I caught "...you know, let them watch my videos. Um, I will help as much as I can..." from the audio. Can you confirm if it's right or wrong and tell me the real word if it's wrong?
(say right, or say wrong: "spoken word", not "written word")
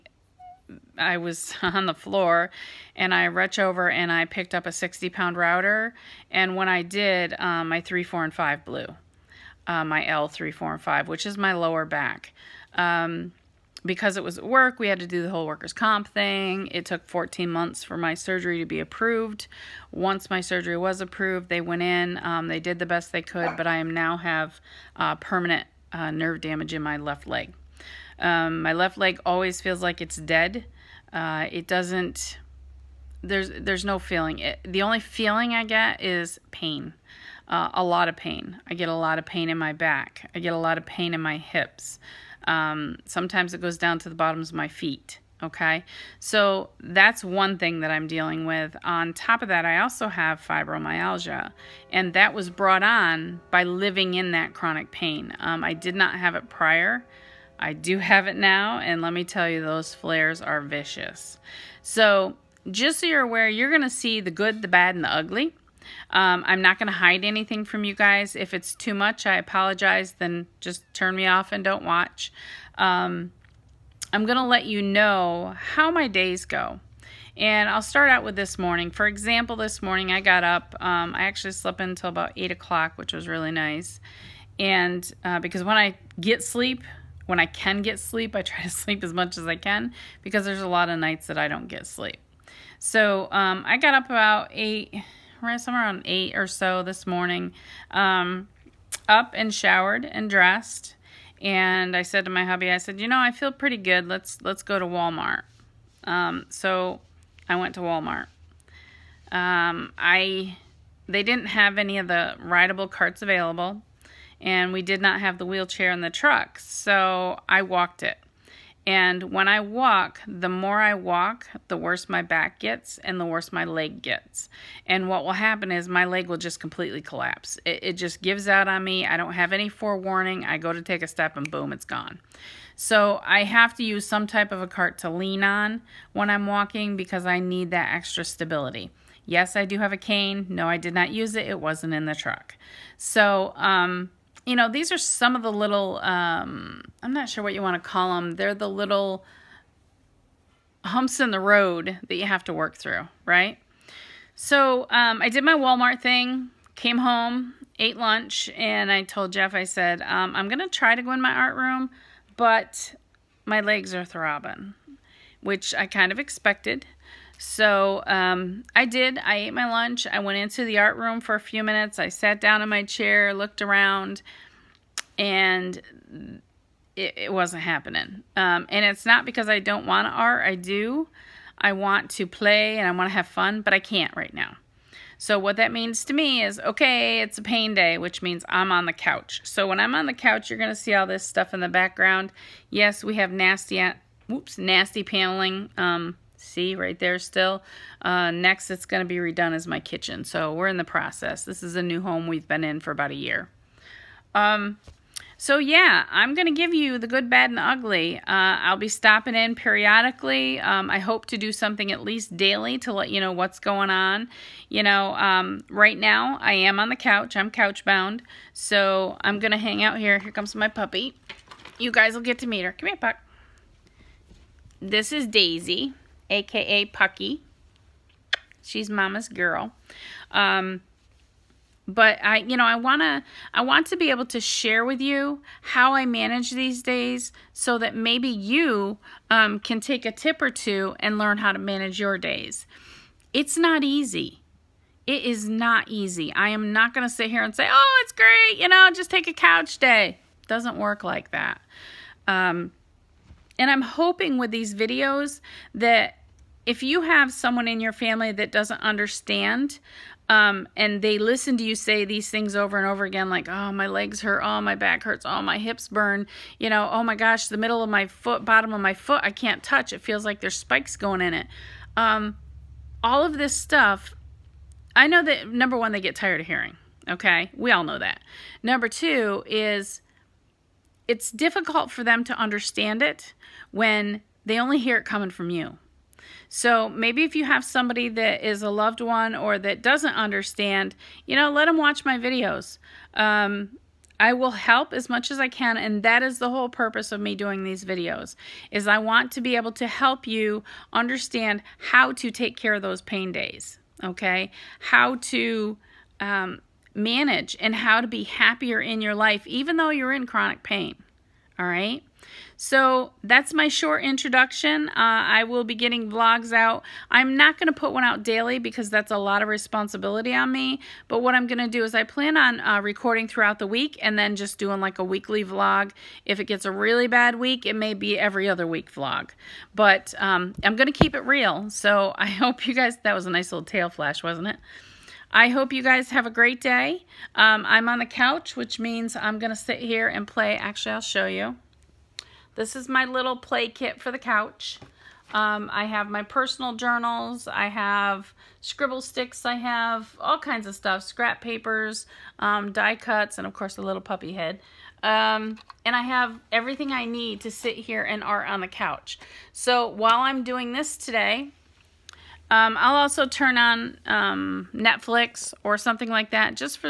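right.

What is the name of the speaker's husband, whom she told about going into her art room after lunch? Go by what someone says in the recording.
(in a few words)
Jeff.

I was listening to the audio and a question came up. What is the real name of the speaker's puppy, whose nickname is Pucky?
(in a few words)
Daisy.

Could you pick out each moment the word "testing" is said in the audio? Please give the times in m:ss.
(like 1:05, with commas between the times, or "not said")
not said.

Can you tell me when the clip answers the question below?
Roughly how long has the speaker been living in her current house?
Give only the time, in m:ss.
3:22.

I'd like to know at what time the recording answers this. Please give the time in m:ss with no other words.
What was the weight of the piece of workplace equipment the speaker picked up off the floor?
0:04.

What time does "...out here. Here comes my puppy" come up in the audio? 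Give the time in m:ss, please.
3:39.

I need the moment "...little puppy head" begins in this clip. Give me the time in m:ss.
5:53.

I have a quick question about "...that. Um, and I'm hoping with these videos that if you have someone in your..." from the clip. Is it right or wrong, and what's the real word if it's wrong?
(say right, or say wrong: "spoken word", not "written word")
right.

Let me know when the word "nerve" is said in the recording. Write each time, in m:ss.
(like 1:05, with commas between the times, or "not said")
0:26.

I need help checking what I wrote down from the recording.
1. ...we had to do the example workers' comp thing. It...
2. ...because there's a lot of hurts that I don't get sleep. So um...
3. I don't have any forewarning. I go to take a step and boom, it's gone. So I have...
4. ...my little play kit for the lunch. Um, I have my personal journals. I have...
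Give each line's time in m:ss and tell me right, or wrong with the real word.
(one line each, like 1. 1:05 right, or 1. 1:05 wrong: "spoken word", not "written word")
1. 0:14 wrong: "whole", not "example"
2. 1:30 wrong: "nights", not "hurts"
3. 2:09 right
4. 5:42 wrong: "couch", not "lunch".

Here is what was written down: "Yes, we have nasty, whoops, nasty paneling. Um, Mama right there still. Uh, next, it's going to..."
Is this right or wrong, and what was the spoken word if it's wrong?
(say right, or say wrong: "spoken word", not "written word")
wrong: "See", not "Mama".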